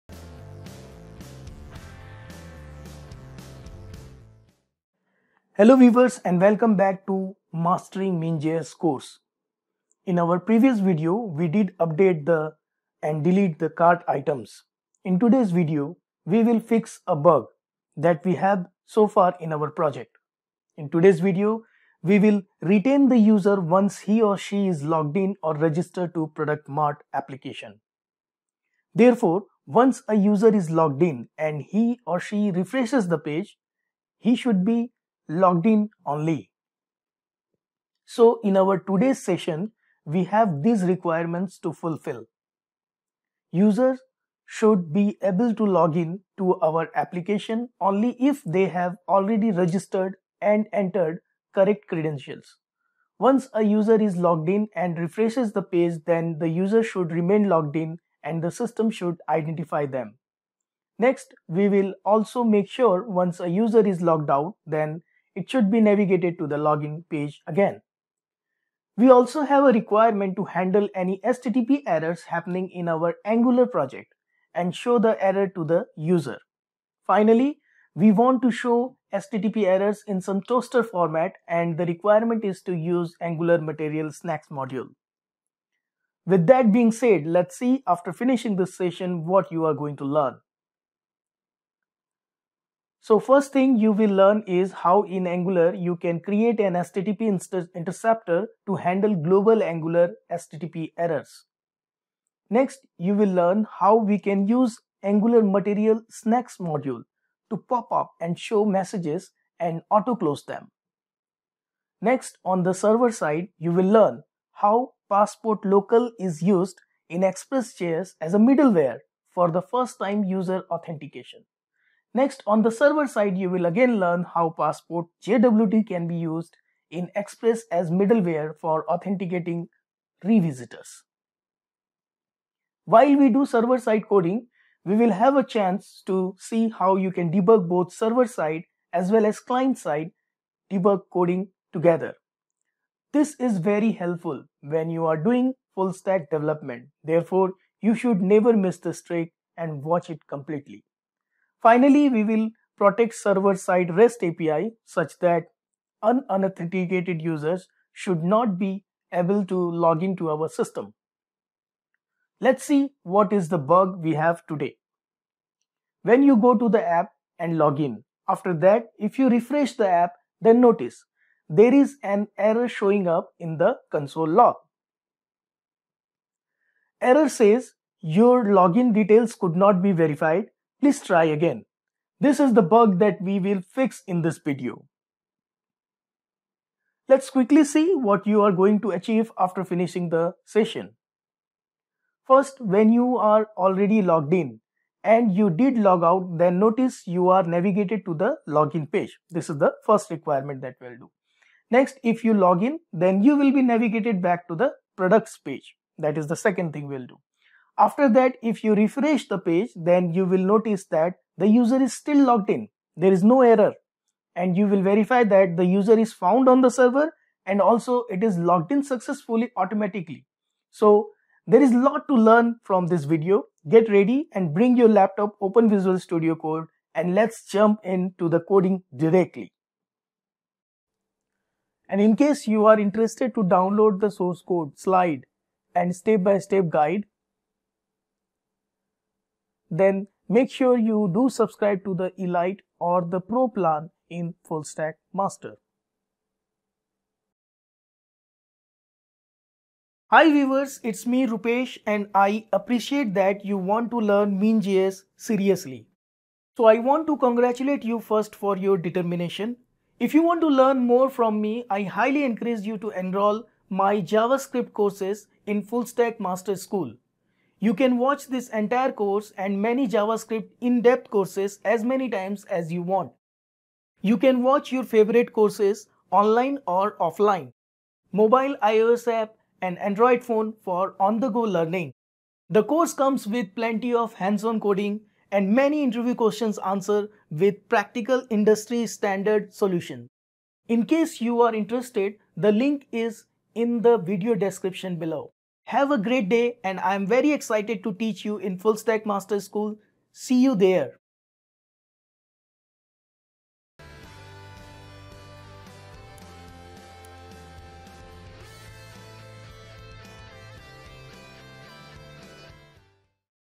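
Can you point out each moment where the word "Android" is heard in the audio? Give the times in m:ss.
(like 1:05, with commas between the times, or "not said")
4:39.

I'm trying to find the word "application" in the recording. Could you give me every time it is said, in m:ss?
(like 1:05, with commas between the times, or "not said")
0:27, 0:46.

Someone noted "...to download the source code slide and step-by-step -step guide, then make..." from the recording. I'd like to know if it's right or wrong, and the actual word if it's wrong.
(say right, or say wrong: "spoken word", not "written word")
right.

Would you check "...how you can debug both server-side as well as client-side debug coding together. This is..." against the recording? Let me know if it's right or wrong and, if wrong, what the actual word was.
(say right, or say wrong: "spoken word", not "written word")
right.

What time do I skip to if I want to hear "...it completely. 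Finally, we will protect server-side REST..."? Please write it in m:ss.
2:30.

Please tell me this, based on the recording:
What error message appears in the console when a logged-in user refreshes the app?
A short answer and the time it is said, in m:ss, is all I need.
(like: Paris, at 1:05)
Your login details could not be verified, at 2:57.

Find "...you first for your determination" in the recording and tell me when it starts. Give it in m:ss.
4:17.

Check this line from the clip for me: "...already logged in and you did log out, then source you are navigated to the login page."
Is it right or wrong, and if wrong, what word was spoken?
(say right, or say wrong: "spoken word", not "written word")
wrong: "notice", not "source".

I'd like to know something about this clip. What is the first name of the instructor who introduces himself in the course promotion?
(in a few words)
Rupesh.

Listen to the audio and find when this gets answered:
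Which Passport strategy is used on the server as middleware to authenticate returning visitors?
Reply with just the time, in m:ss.
2:04.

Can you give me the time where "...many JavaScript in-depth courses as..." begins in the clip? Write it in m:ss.
4:29.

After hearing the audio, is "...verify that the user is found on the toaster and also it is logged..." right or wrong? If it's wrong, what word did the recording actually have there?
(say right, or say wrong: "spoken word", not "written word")
wrong: "server", not "toaster".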